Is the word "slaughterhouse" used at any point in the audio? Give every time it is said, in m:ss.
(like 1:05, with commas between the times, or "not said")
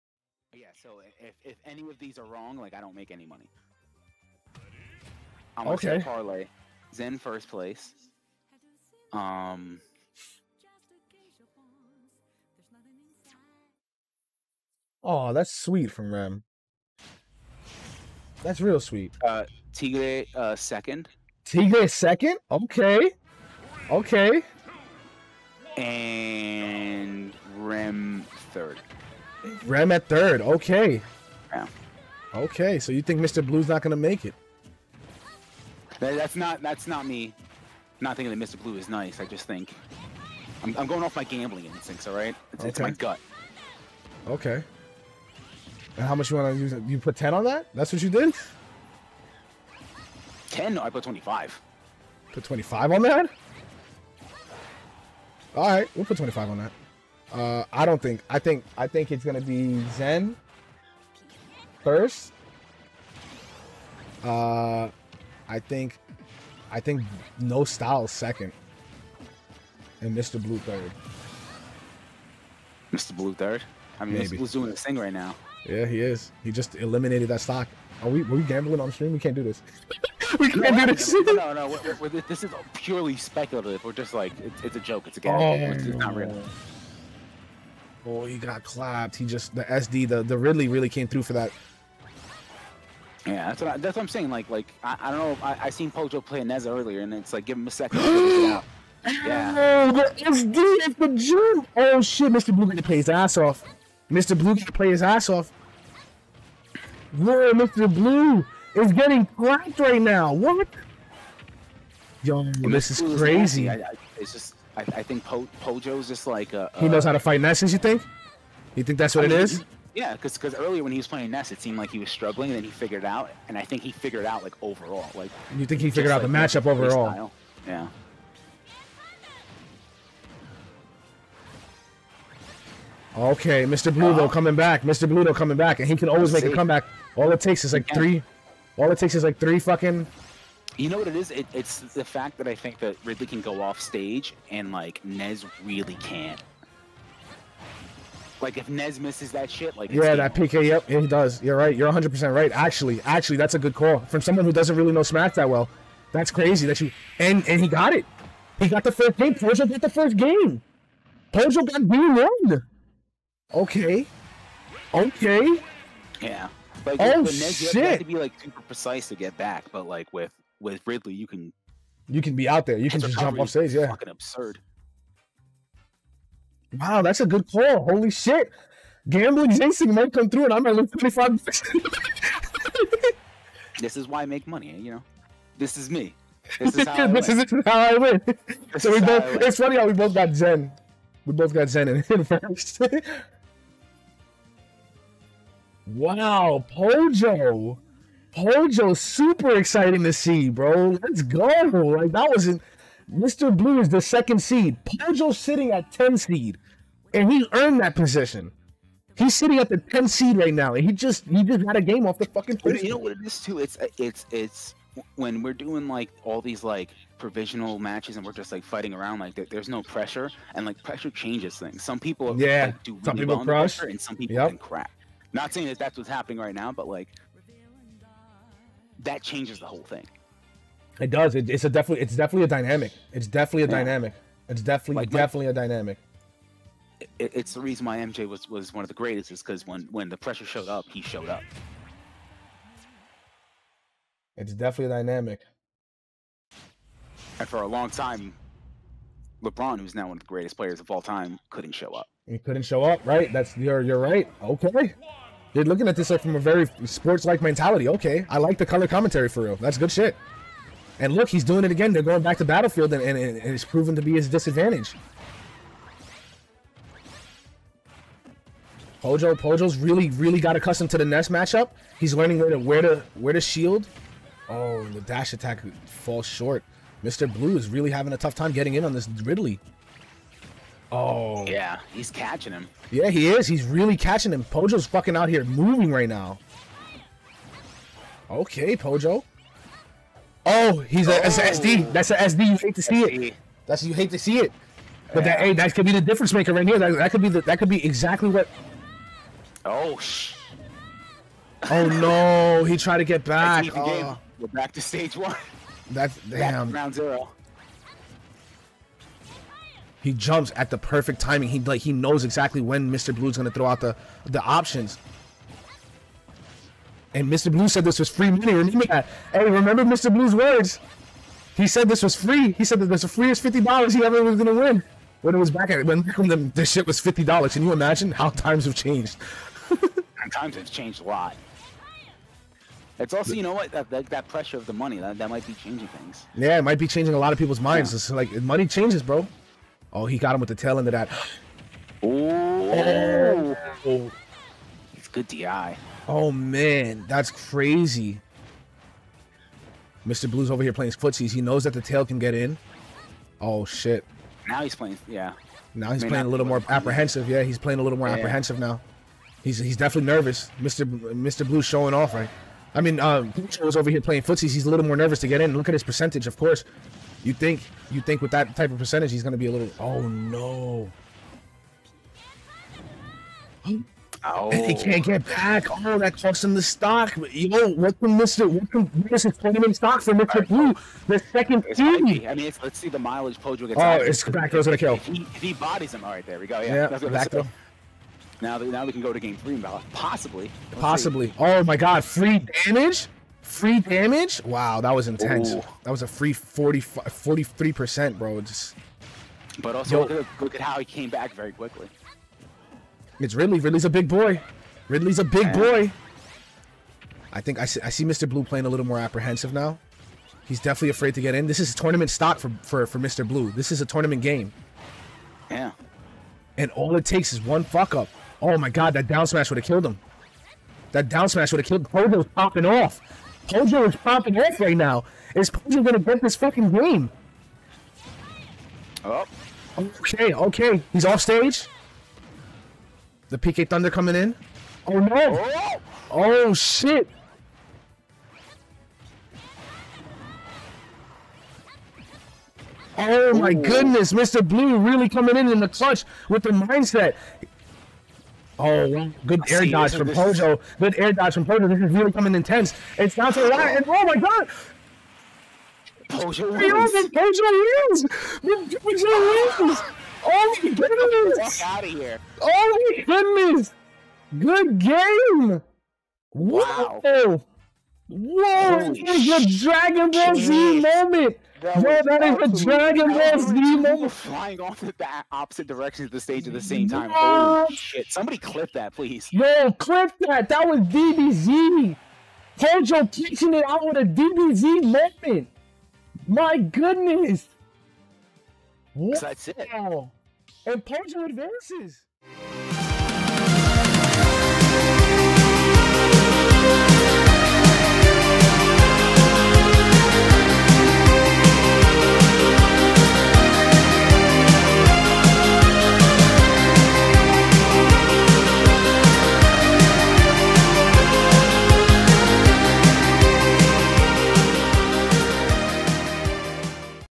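not said.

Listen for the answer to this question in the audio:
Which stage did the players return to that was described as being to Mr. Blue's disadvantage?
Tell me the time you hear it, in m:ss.
4:22.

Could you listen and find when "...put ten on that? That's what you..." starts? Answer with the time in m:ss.
0:46.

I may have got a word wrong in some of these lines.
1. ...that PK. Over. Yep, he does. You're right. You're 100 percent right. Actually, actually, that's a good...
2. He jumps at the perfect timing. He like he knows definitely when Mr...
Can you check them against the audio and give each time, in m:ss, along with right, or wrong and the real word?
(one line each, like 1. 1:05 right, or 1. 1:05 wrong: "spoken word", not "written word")
1. 2:30 right
2. 5:10 wrong: "exactly", not "definitely".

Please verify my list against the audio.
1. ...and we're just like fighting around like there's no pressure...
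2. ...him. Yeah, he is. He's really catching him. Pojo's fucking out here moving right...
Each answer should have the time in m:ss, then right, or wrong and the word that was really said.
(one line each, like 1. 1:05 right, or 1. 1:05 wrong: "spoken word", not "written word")
1. 3:38 right
2. 4:42 right.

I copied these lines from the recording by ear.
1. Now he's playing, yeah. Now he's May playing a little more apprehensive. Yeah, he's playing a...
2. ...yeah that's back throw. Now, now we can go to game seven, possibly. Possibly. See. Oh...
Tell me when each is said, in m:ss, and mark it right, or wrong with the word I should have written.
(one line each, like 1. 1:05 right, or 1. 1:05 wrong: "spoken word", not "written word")
1. 5:54 right
2. 6:26 wrong: "three", not "seven".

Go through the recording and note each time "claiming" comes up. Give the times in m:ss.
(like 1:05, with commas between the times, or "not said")
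6:19.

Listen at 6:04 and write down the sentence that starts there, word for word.
He's a little more nervous to get in.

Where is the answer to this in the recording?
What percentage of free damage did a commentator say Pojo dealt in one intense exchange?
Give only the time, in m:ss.
6:36.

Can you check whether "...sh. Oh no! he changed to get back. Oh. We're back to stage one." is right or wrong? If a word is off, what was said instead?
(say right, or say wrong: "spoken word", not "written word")
wrong: "tried", not "changed".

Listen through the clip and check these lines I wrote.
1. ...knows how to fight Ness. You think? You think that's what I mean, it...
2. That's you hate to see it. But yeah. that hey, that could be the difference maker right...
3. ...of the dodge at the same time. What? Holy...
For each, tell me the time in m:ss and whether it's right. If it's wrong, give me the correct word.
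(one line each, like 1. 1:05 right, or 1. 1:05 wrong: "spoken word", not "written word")
1. 1:56 right
2. 4:53 right
3. 7:56 wrong: "stage", not "dodge".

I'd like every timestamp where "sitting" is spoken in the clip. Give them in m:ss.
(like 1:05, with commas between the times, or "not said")
3:25, 3:29.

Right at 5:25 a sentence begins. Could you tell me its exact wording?
When it was back at when, when the, this shit was fifty dollars.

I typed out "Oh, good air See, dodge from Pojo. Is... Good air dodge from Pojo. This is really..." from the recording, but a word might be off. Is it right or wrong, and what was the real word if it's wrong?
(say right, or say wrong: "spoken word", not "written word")
right.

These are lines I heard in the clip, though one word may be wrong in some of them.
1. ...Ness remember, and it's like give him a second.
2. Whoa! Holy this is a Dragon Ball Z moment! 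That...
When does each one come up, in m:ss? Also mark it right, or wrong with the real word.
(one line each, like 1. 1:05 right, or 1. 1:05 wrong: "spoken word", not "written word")
1. 1:36 wrong: "earlier", not "remember"
2. 7:48 right.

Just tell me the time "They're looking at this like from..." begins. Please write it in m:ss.
4:15.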